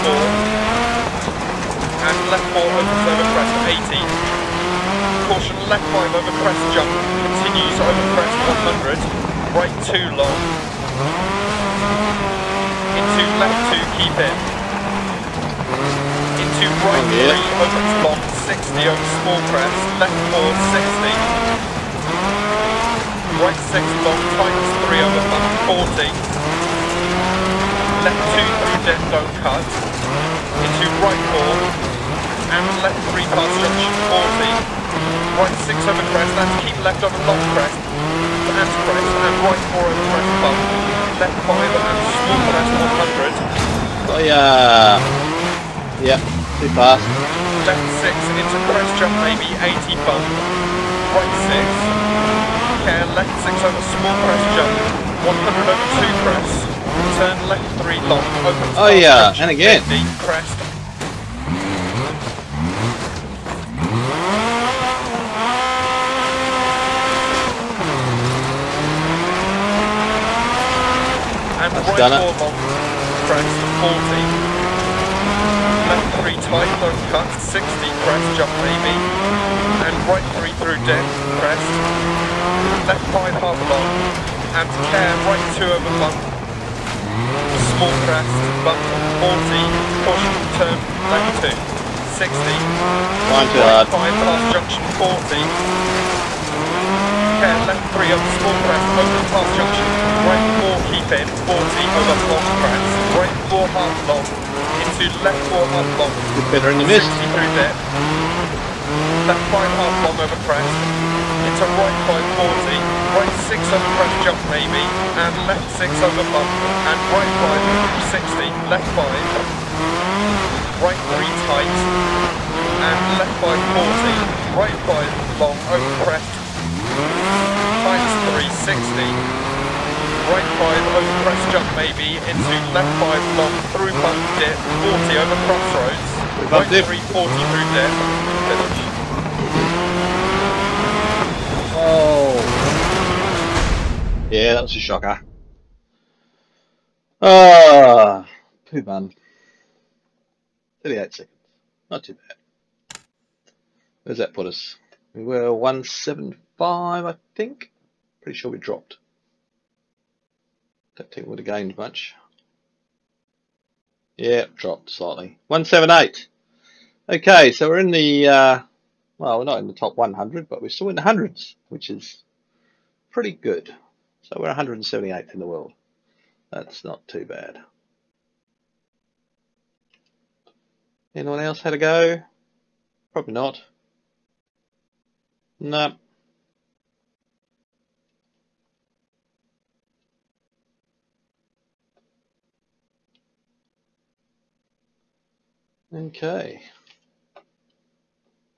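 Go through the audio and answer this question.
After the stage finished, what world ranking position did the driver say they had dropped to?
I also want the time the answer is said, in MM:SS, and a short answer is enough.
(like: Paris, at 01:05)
178th, at 02:54.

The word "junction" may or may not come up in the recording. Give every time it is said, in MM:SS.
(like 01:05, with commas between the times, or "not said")
00:33, 01:34, 01:39.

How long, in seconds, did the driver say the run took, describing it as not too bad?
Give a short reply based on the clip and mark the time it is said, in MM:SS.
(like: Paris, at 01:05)
38 seconds, at 02:30.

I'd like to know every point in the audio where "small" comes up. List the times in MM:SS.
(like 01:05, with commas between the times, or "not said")
00:19, 00:42, 00:53, 01:27, 01:38.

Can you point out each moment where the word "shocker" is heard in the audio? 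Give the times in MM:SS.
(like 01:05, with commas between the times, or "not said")
02:24.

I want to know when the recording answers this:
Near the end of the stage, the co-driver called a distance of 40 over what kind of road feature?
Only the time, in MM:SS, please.
02:15.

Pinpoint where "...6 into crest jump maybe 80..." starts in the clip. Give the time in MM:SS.
00:48.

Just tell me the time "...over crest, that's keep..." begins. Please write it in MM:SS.
00:35.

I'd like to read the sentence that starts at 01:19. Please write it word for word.
And right 3 through deck, press.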